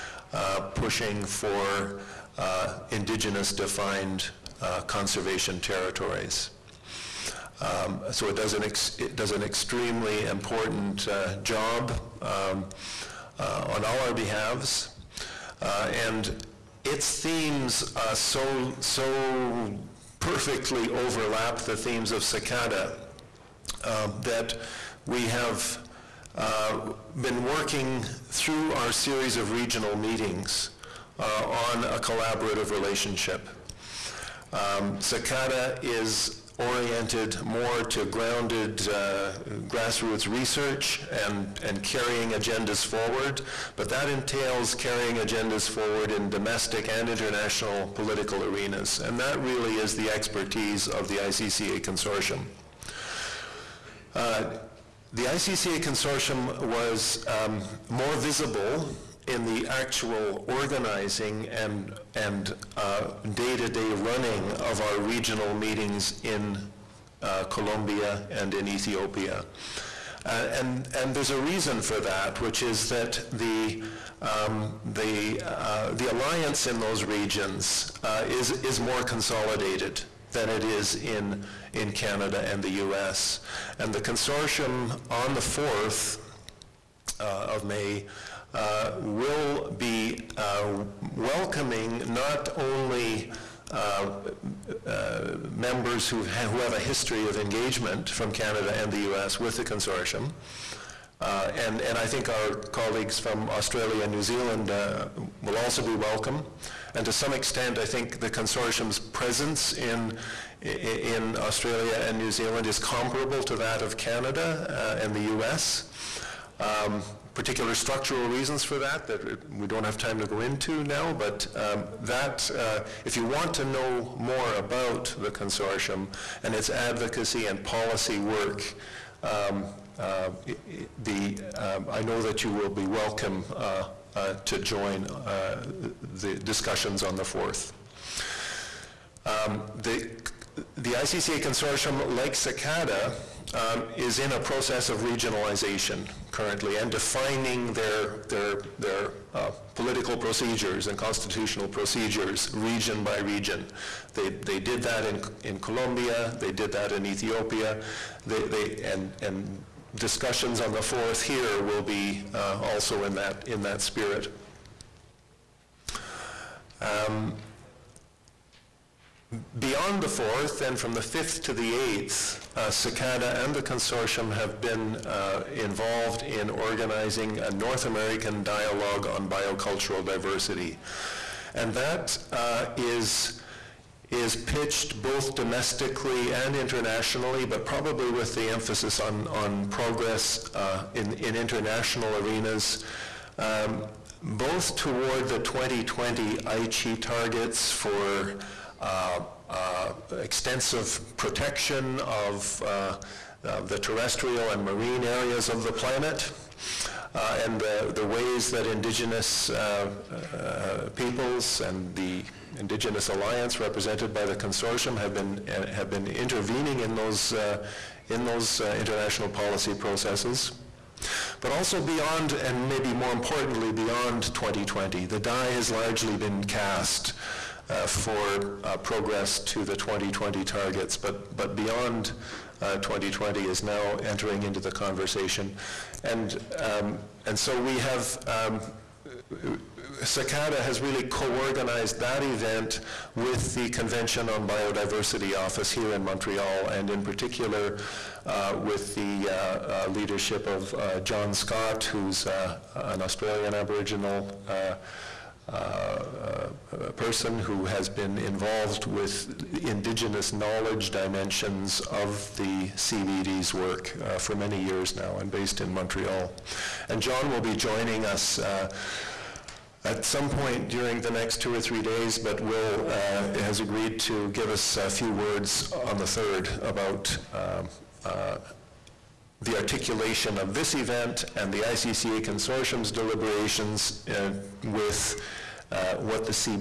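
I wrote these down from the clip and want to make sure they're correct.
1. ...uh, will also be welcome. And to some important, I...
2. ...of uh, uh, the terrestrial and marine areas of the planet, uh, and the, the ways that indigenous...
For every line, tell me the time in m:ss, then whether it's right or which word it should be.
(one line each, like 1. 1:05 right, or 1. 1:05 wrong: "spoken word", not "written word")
1. 1:44 wrong: "extent", not "important"
2. 3:22 right.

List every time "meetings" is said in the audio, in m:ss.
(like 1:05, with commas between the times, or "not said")
0:29, 1:05.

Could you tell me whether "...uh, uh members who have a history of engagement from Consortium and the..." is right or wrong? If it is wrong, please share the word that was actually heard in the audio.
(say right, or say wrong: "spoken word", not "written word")
wrong: "Canada", not "Consortium".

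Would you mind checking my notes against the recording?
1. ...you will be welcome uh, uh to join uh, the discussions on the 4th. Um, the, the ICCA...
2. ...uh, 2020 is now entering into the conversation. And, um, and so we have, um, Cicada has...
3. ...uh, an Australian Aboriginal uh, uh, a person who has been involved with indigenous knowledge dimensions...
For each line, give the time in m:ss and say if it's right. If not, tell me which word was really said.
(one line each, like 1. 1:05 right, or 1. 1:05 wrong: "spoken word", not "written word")
1. 2:12 right
2. 3:52 right
3. 4:12 right.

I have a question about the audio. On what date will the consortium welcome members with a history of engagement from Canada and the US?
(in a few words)
4th of May.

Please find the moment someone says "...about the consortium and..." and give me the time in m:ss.
2:04.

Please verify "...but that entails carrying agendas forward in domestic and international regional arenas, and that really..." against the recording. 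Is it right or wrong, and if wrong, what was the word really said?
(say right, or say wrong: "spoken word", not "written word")
wrong: "political", not "regional".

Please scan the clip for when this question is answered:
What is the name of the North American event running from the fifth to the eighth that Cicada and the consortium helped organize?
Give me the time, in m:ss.
2:57.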